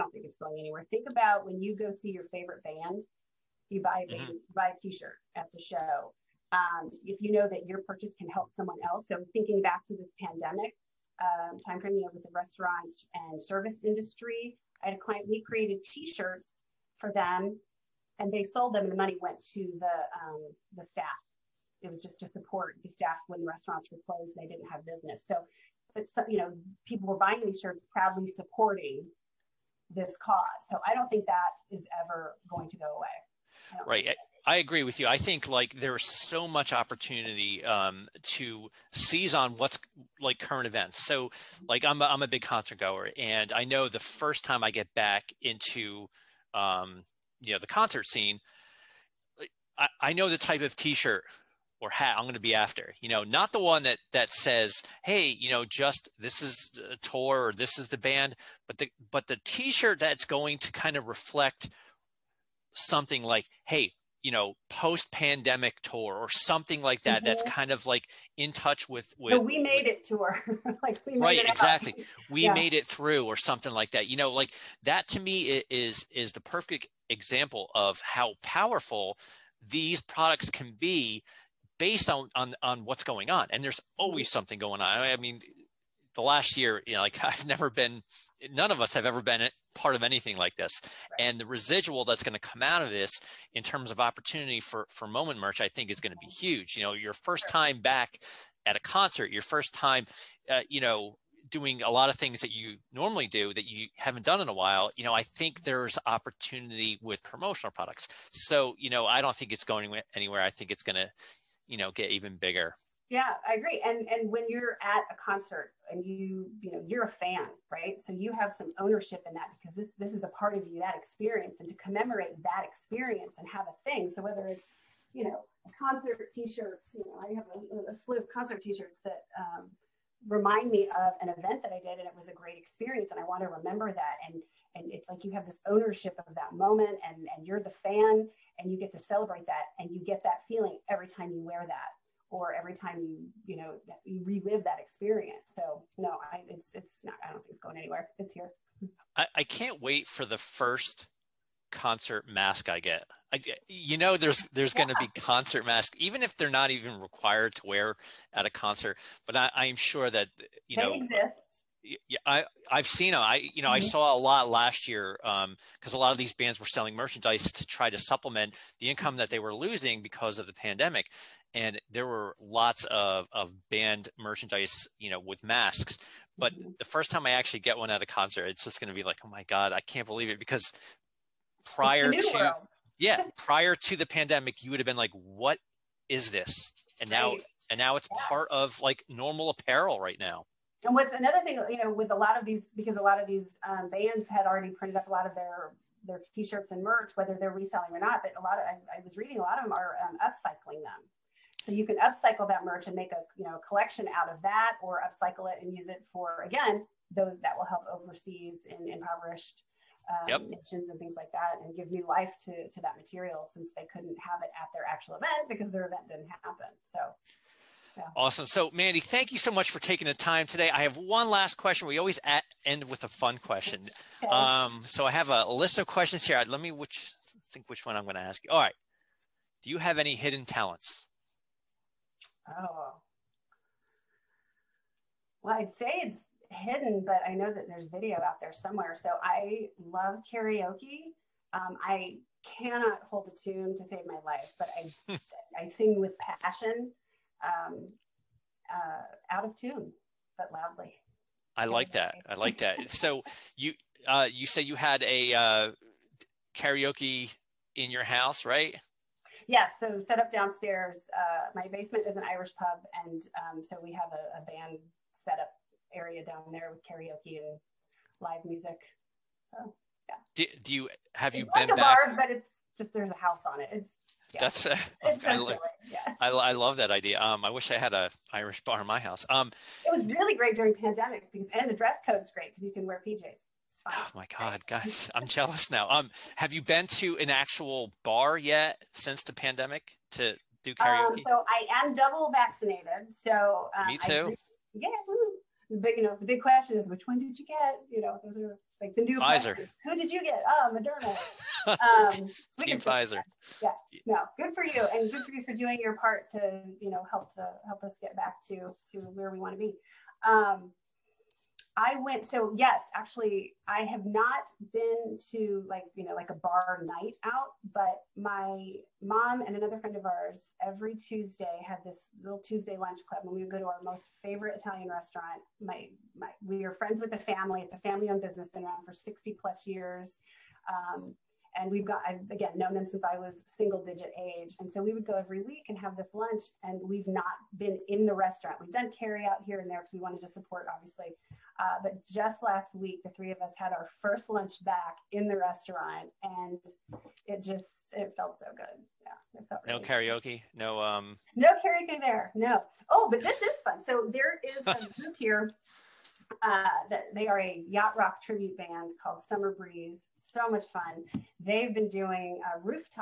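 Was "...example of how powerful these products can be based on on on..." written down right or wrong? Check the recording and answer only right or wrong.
right.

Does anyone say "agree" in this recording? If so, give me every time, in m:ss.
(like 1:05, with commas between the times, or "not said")
0:34, 1:53.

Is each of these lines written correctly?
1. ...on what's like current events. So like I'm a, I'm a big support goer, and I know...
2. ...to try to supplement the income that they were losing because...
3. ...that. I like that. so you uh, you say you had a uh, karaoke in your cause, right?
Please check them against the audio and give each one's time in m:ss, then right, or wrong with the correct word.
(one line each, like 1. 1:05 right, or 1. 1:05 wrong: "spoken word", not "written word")
1. 0:39 wrong: "concert", not "support"
2. 2:47 right
3. 4:11 wrong: "house", not "cause".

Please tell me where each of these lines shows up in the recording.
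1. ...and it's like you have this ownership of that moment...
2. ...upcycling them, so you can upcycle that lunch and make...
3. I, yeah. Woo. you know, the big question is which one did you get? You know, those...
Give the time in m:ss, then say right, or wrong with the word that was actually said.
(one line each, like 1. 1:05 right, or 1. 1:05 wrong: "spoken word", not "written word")
1. 2:14 right
2. 3:20 wrong: "merch", not "lunch"
3. 4:54 right.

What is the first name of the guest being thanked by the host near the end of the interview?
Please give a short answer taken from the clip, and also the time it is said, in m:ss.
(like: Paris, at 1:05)
Mandi, at 3:38.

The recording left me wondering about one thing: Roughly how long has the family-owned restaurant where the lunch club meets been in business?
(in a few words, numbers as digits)
60 plus years.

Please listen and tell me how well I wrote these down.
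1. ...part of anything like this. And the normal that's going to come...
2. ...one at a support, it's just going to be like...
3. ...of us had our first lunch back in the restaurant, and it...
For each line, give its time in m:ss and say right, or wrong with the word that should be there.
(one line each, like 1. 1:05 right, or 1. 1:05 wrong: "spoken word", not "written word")
1. 1:29 wrong: "residual", not "normal"
2. 2:57 wrong: "concert", not "support"
3. 5:43 right.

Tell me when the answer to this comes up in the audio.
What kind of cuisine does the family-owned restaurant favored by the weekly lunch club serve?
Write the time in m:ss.
5:24.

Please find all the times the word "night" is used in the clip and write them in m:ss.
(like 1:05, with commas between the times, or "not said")
5:16.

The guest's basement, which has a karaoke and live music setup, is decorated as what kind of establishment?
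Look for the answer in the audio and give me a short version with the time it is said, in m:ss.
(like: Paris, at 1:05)
An Irish pub, at 4:22.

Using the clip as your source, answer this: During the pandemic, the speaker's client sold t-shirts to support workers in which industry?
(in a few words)
Restaurant and service industry.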